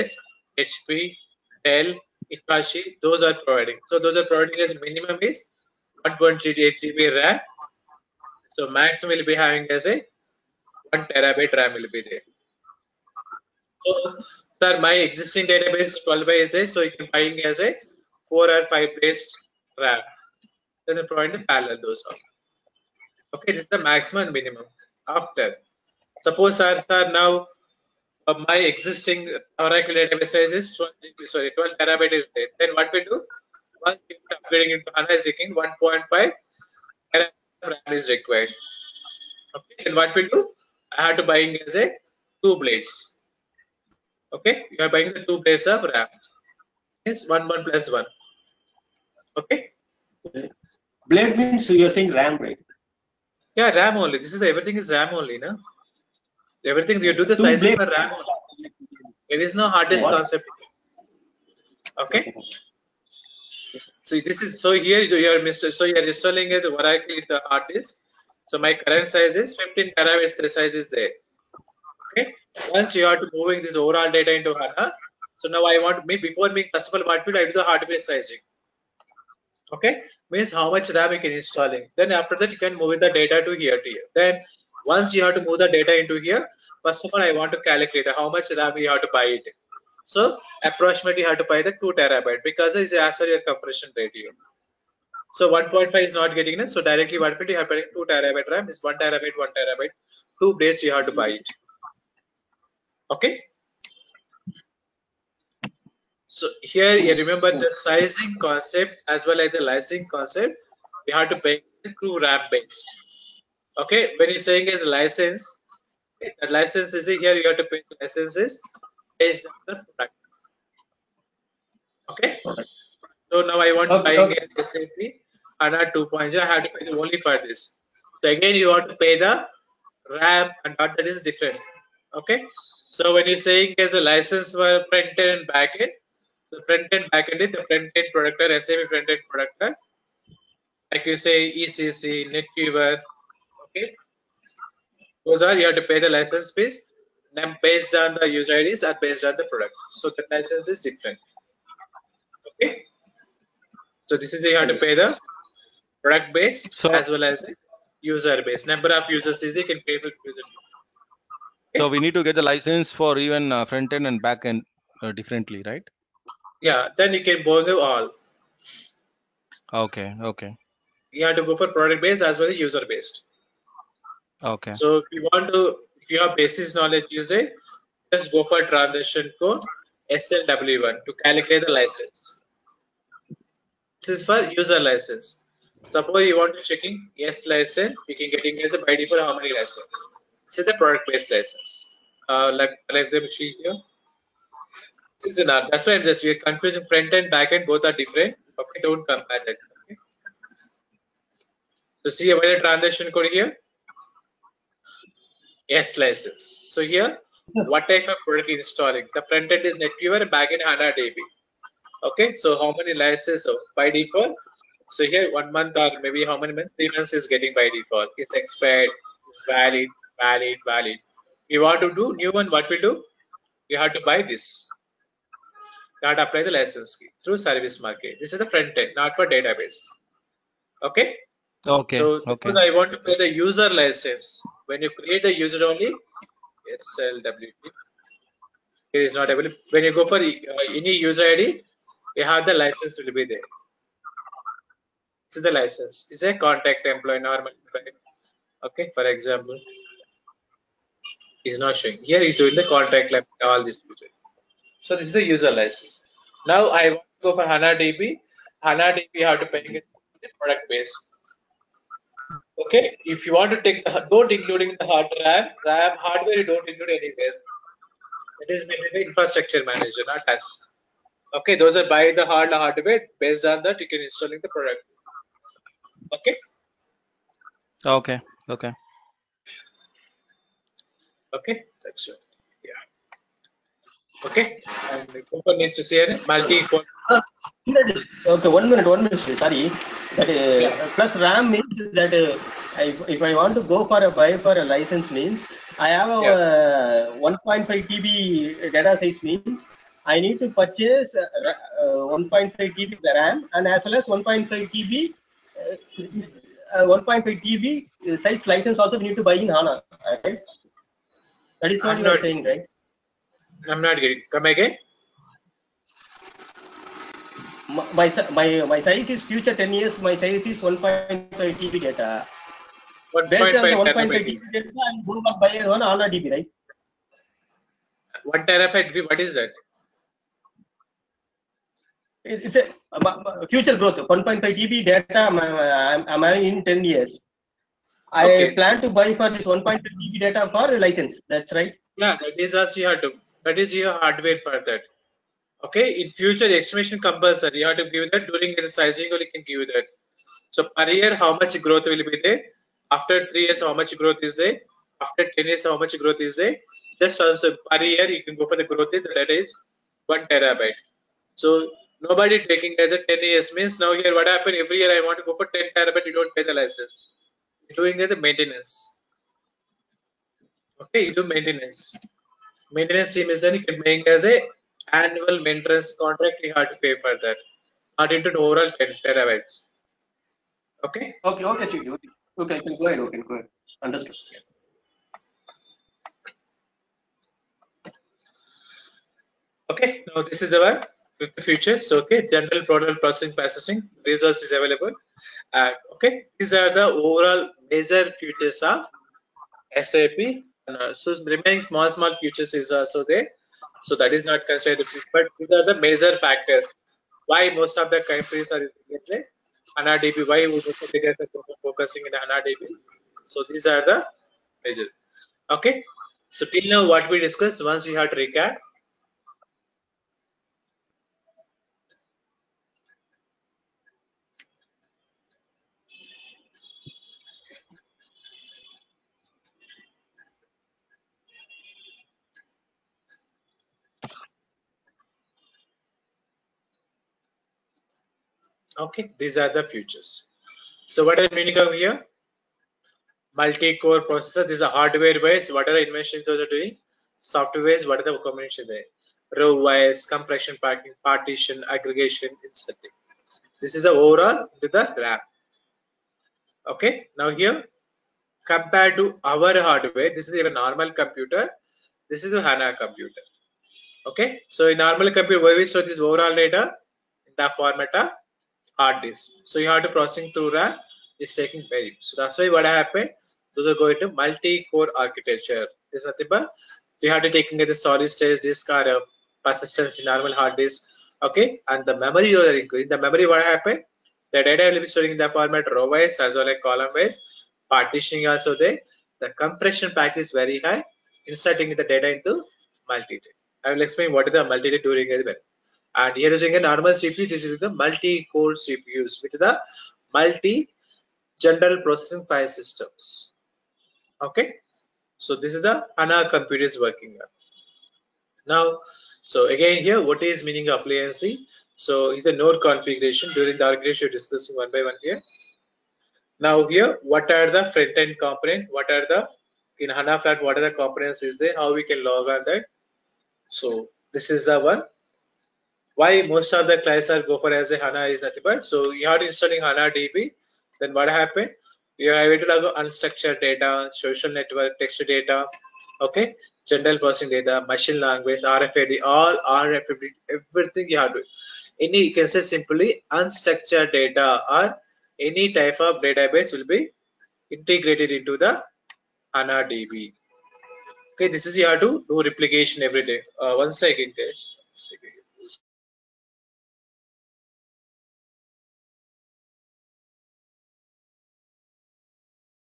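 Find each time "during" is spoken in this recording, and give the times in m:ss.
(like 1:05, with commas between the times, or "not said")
5:48, 8:14, 8:33.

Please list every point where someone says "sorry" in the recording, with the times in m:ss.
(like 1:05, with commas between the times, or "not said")
0:31, 4:49.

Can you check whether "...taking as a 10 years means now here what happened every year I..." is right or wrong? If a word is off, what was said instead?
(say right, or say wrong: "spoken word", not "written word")
right.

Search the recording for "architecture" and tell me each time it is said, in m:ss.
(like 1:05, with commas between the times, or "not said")
7:54, 8:33.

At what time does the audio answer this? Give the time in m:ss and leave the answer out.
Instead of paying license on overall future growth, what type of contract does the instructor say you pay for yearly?
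6:14.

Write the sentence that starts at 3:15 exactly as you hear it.
That's why just we're confusing front end, back end, both are different.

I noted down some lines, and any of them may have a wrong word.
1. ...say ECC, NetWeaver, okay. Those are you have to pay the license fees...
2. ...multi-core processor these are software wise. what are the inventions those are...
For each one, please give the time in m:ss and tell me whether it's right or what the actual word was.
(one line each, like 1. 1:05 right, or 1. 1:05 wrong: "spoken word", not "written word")
1. 2:21 right
2. 7:23 wrong: "hardware", not "software".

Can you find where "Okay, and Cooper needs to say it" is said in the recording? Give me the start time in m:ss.
4:44.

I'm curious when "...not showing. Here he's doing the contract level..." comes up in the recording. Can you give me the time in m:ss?
4:11.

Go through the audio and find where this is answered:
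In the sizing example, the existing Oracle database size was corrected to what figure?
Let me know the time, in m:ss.
0:31.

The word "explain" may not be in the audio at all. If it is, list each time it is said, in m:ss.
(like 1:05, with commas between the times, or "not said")
8:13.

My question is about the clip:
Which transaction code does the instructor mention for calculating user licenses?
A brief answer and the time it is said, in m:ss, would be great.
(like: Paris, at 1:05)
SLW1, at 3:00.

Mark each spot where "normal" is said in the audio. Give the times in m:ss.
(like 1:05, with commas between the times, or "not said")
4:07, 7:40, 7:44, 8:00, 8:16.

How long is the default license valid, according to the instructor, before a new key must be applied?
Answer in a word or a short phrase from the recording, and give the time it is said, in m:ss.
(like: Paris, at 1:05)
3 months, at 3:36.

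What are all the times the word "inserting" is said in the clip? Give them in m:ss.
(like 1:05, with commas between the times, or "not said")
7:32, 8:11.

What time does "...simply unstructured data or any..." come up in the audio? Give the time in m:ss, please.
9:02.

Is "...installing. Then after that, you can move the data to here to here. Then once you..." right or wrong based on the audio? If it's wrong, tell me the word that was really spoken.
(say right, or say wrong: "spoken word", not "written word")
right.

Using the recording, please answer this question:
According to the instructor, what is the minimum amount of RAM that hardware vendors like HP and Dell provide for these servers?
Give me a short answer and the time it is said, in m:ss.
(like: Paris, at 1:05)
128 GB, at 0:06.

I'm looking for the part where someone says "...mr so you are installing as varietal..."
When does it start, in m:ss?
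1:05.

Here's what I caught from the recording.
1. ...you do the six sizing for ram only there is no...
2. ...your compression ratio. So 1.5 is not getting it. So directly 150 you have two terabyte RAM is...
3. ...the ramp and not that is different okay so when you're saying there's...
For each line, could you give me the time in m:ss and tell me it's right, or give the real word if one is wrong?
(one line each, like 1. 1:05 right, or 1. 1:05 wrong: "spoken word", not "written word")
1. 0:57 wrong: "two", not "six"
2. 1:33 right
3. 2:09 right.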